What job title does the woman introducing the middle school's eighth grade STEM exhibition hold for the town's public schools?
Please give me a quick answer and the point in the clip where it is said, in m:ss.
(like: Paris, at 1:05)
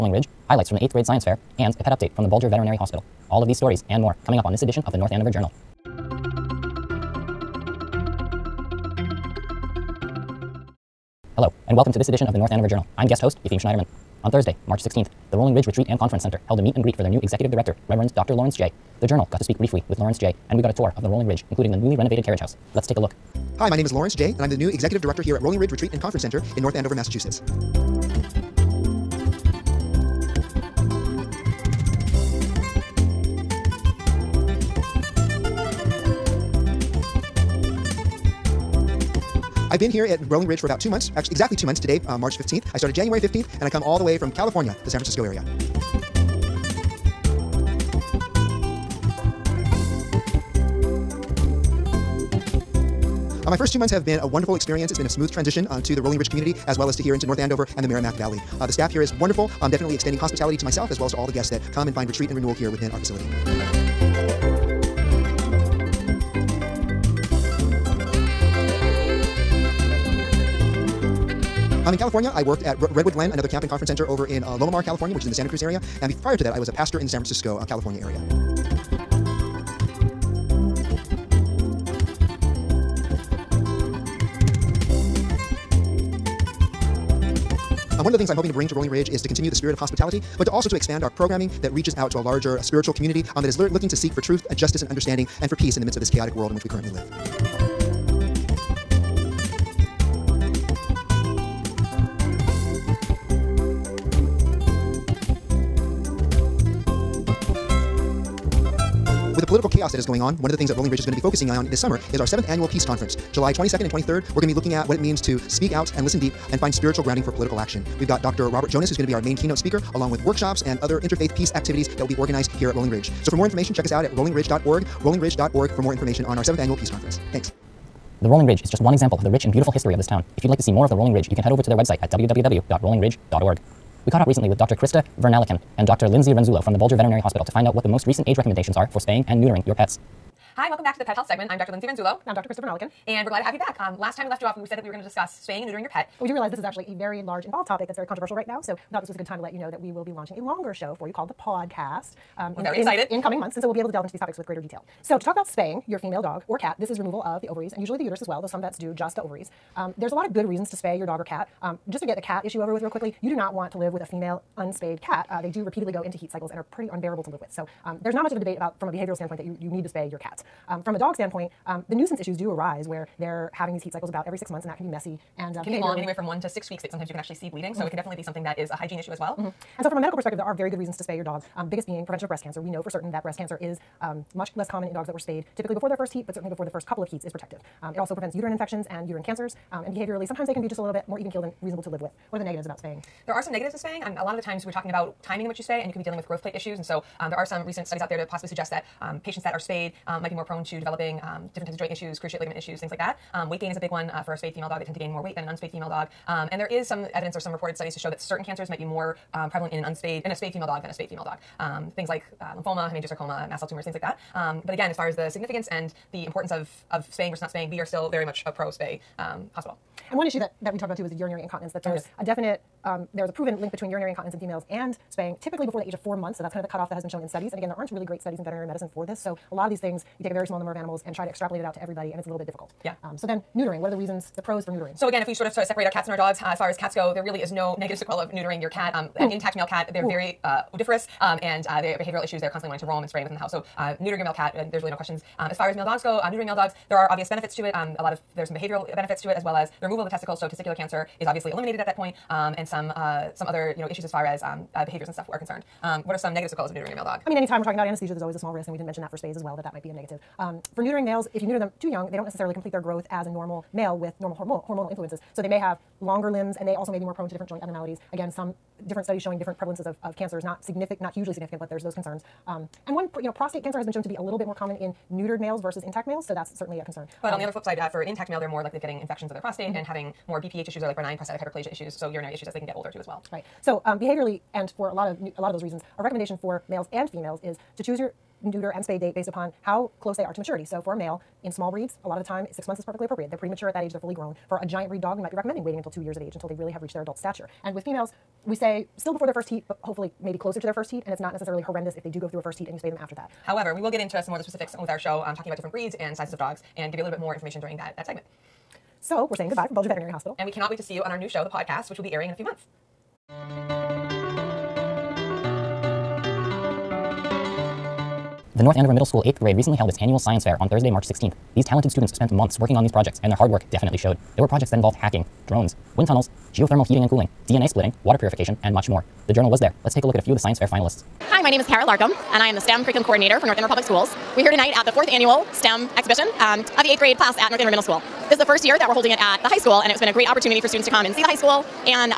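STEM Curriculum Coordinator, at 5:32.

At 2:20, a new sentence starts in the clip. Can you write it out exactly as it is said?
Hi, welcome back to the Pet Health segment.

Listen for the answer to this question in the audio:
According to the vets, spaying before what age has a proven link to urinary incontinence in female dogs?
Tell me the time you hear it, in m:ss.
3:45.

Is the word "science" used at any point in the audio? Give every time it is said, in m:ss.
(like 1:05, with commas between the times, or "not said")
0:01, 5:20, 5:30.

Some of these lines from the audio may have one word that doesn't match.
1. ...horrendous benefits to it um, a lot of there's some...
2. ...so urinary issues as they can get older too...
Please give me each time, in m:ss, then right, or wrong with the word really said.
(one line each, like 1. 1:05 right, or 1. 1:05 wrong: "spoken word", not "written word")
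1. 4:07 wrong: "obvious", not "horrendous"
2. 4:41 right.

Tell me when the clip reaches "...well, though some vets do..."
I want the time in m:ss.
2:38.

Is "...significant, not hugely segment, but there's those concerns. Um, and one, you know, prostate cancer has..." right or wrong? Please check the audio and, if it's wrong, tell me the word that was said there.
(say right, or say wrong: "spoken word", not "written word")
wrong: "significant", not "segment".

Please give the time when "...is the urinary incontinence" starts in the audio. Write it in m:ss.
3:41.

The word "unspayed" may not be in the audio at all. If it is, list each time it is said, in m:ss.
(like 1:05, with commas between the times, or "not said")
2:44, 3:25, 3:29.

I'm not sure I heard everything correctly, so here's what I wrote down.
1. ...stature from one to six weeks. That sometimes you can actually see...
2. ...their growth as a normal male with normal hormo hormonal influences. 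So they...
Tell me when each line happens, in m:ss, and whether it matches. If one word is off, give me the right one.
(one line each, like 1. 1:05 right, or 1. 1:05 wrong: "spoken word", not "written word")
1. 2:55 wrong: "anywhere", not "stature"
2. 4:22 right.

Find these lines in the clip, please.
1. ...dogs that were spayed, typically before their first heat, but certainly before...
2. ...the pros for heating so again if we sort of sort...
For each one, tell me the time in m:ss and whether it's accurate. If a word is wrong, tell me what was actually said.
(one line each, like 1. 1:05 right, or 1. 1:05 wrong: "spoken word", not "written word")
1. 3:04 right
2. 3:54 wrong: "neutering", not "heating".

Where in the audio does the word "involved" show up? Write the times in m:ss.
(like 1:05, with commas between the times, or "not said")
2:27, 5:24.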